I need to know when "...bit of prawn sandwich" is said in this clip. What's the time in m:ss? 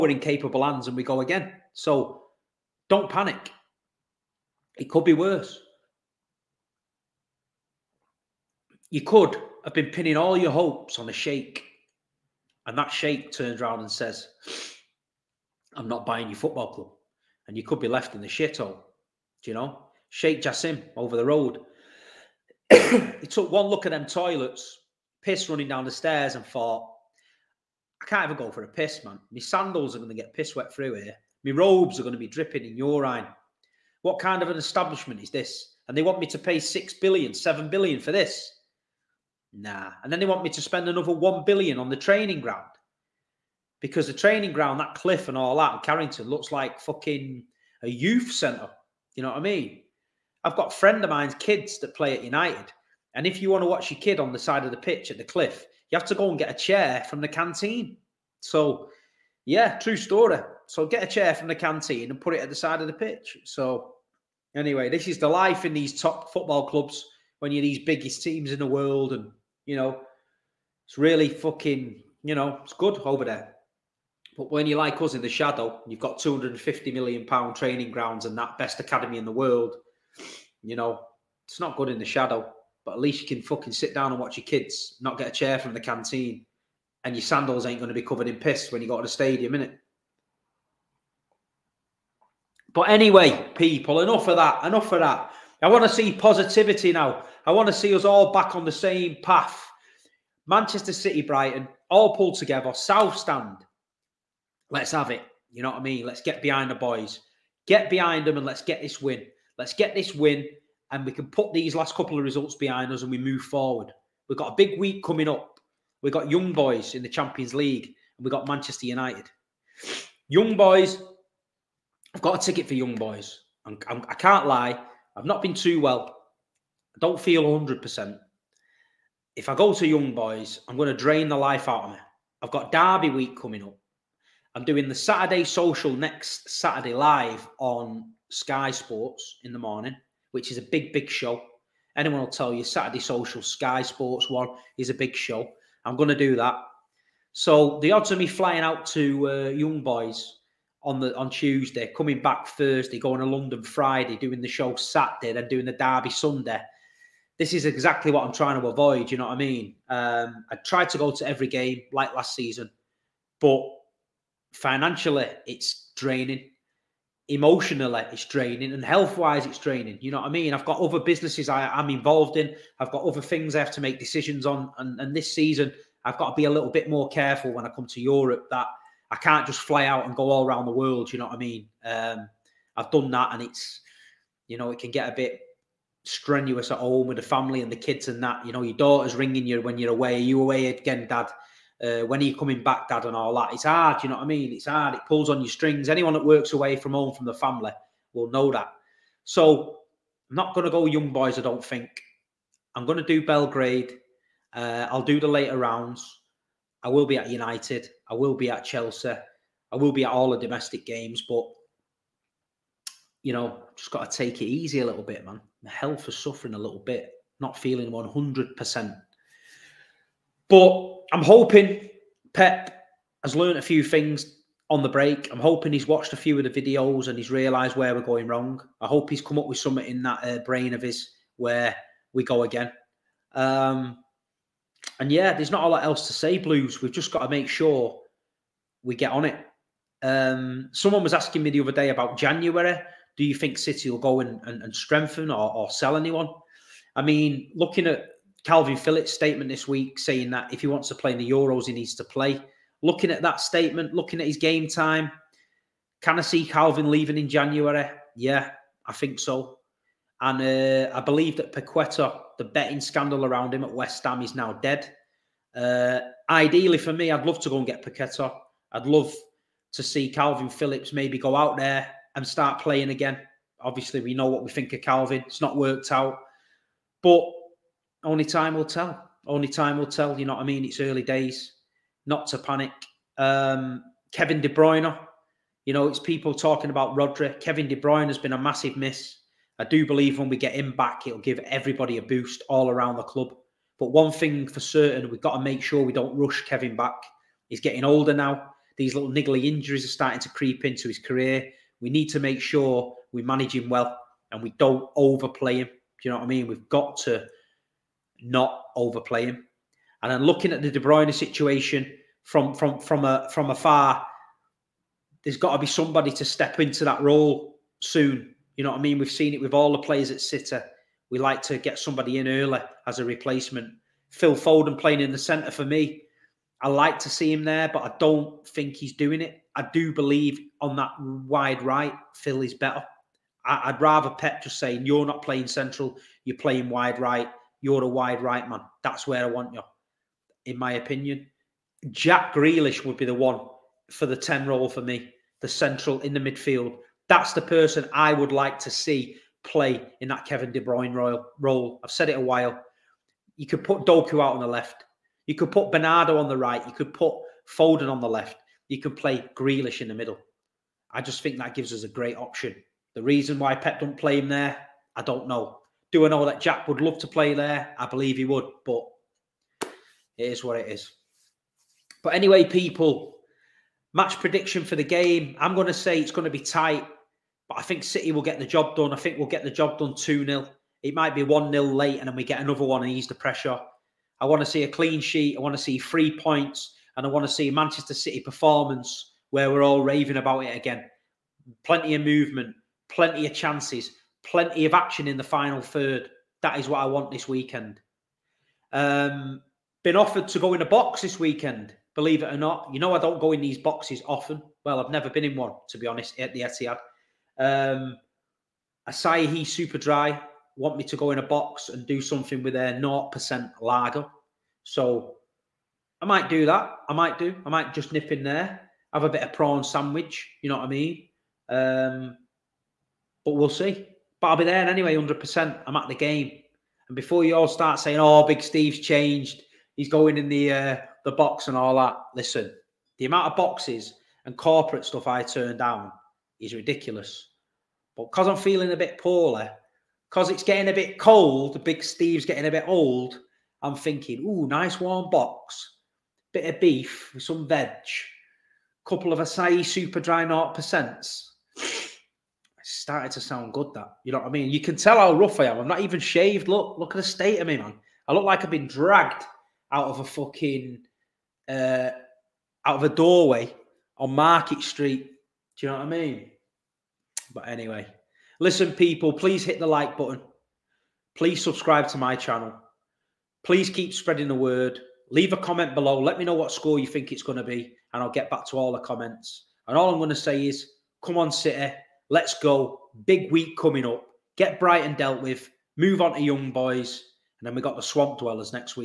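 6:59.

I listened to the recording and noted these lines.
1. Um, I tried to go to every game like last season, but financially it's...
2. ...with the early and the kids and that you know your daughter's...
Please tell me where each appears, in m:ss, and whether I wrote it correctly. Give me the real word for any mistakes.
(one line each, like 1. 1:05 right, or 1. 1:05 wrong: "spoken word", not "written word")
1. 2:39 right
2. 3:07 wrong: "family", not "early".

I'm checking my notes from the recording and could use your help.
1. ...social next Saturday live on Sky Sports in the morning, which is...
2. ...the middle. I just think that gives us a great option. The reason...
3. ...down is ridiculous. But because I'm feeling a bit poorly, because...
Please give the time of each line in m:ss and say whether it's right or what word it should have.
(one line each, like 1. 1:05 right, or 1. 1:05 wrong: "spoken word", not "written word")
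1. 2:15 right
2. 5:59 right
3. 7:15 right.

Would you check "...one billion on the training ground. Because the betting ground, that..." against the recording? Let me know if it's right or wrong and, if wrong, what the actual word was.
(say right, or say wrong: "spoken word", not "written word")
wrong: "training", not "betting".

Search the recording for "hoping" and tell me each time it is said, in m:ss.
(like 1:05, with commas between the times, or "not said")
3:41, 3:45.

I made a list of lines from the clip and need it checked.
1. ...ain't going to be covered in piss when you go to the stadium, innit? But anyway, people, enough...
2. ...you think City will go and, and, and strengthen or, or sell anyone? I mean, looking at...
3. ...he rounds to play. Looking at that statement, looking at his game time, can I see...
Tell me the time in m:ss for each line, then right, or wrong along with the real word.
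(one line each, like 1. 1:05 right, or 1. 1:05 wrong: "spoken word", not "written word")
1. 1:27 right
2. 4:03 right
3. 4:11 wrong: "needs", not "rounds".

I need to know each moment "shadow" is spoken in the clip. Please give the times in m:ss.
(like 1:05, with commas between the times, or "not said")
1:15, 1:22.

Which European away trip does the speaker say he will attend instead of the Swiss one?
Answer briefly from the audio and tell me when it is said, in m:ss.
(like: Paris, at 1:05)
Belgrade, at 3:23.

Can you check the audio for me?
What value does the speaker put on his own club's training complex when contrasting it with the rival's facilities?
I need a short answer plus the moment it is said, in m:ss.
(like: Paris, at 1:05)
250 million pounds, at 1:16.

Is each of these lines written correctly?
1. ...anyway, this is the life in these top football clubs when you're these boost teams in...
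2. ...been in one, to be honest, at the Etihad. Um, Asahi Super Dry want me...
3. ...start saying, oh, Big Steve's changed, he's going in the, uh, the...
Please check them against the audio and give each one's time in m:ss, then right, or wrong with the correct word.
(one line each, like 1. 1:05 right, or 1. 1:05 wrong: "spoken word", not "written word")
1. 1:04 wrong: "biggest", not "boost"
2. 6:45 right
3. 7:07 right.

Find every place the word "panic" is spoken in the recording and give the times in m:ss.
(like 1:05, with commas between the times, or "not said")
0:03, 4:42.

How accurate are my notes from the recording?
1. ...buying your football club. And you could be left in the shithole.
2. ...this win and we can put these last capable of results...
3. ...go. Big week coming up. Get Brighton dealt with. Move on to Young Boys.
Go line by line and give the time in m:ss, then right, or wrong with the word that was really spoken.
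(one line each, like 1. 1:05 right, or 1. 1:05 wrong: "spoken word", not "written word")
1. 0:16 right
2. 1:49 wrong: "couple", not "capable"
3. 8:02 right.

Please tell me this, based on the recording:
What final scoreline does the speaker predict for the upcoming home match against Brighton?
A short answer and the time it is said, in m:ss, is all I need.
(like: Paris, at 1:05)
2-0, at 6:19.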